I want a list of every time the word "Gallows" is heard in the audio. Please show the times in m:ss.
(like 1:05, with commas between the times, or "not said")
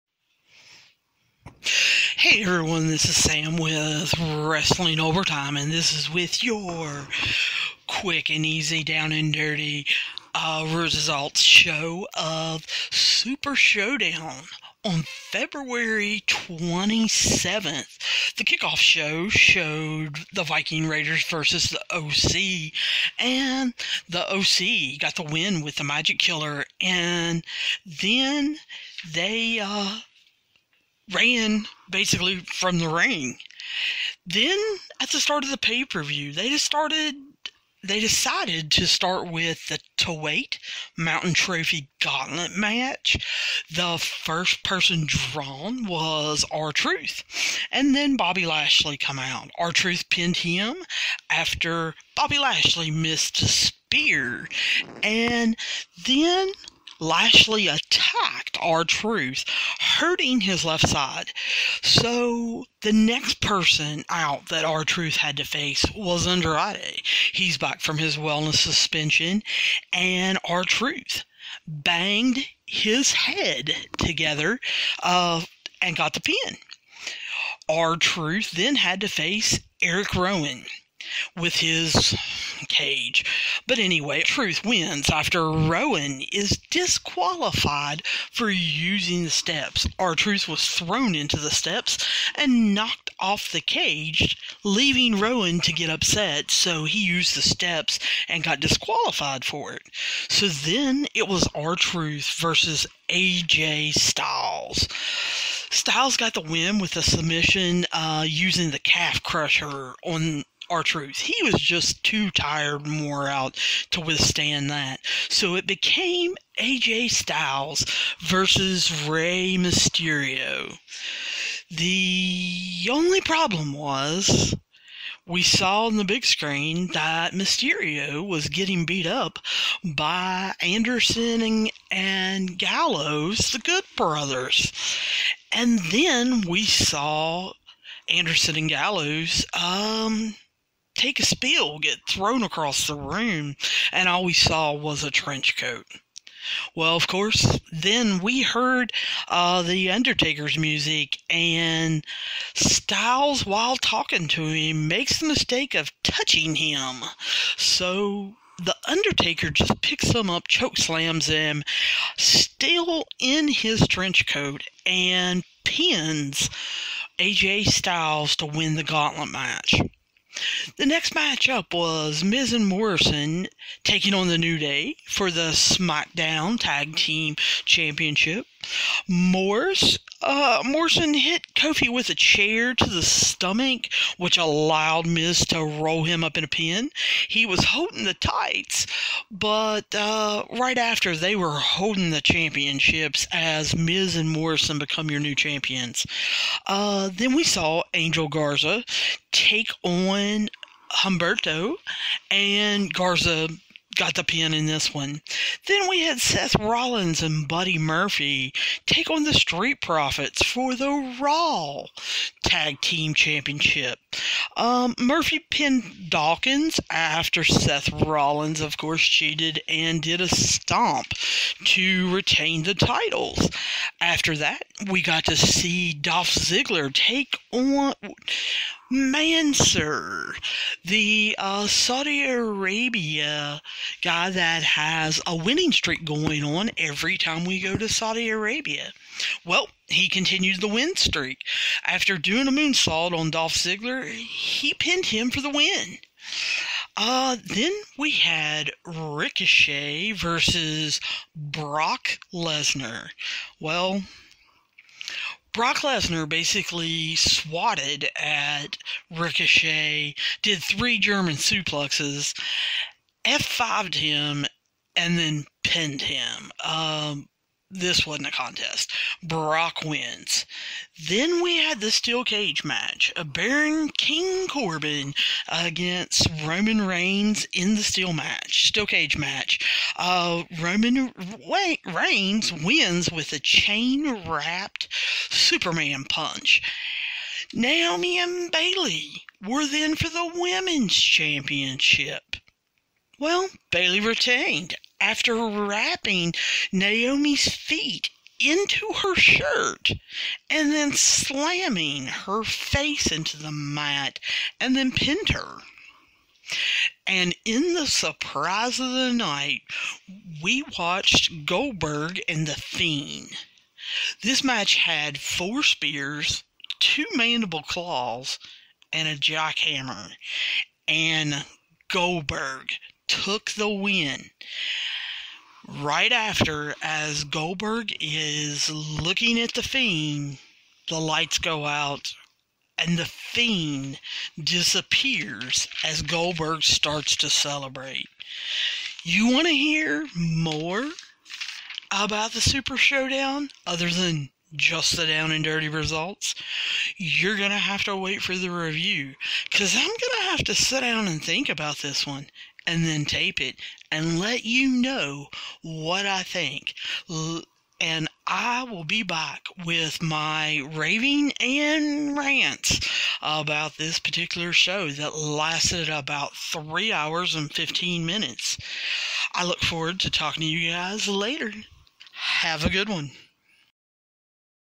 2:12, 2:18.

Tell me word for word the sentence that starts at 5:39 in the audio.
You want to hear more about the Super Showdown other than just the down and dirty results?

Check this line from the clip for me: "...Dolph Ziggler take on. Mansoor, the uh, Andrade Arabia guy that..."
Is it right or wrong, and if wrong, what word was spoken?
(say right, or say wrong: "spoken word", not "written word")
wrong: "Saudi", not "Andrade".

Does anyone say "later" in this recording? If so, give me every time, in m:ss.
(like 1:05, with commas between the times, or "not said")
6:11.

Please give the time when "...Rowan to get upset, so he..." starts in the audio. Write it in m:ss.
1:35.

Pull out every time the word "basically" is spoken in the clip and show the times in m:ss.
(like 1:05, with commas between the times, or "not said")
0:31, 4:16.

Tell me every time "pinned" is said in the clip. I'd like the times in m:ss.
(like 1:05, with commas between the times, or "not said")
0:50, 3:35, 4:04, 4:25, 5:04.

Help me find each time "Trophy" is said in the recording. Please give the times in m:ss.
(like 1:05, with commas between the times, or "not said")
0:41.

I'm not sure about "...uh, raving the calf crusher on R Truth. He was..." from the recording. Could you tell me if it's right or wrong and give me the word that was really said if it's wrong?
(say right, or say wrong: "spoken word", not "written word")
wrong: "using", not "raving".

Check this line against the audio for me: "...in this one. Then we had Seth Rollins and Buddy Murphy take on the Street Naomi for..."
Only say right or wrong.
wrong.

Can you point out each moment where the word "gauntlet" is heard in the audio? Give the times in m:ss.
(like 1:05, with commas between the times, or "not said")
0:41, 2:48.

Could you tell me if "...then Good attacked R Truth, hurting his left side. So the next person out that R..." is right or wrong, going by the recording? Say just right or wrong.
wrong.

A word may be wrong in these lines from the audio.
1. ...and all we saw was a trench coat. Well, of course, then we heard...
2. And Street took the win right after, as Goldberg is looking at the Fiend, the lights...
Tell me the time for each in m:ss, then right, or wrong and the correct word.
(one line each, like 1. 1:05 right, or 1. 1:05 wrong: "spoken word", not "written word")
1. 2:23 right
2. 5:20 wrong: "Goldberg", not "Street".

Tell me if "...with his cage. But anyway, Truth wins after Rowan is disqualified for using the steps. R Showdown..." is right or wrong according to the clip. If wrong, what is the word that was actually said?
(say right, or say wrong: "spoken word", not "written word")
wrong: "Truth", not "Showdown".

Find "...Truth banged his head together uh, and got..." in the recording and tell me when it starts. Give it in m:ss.
1:10.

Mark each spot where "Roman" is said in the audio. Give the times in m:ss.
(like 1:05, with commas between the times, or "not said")
4:36, 4:40.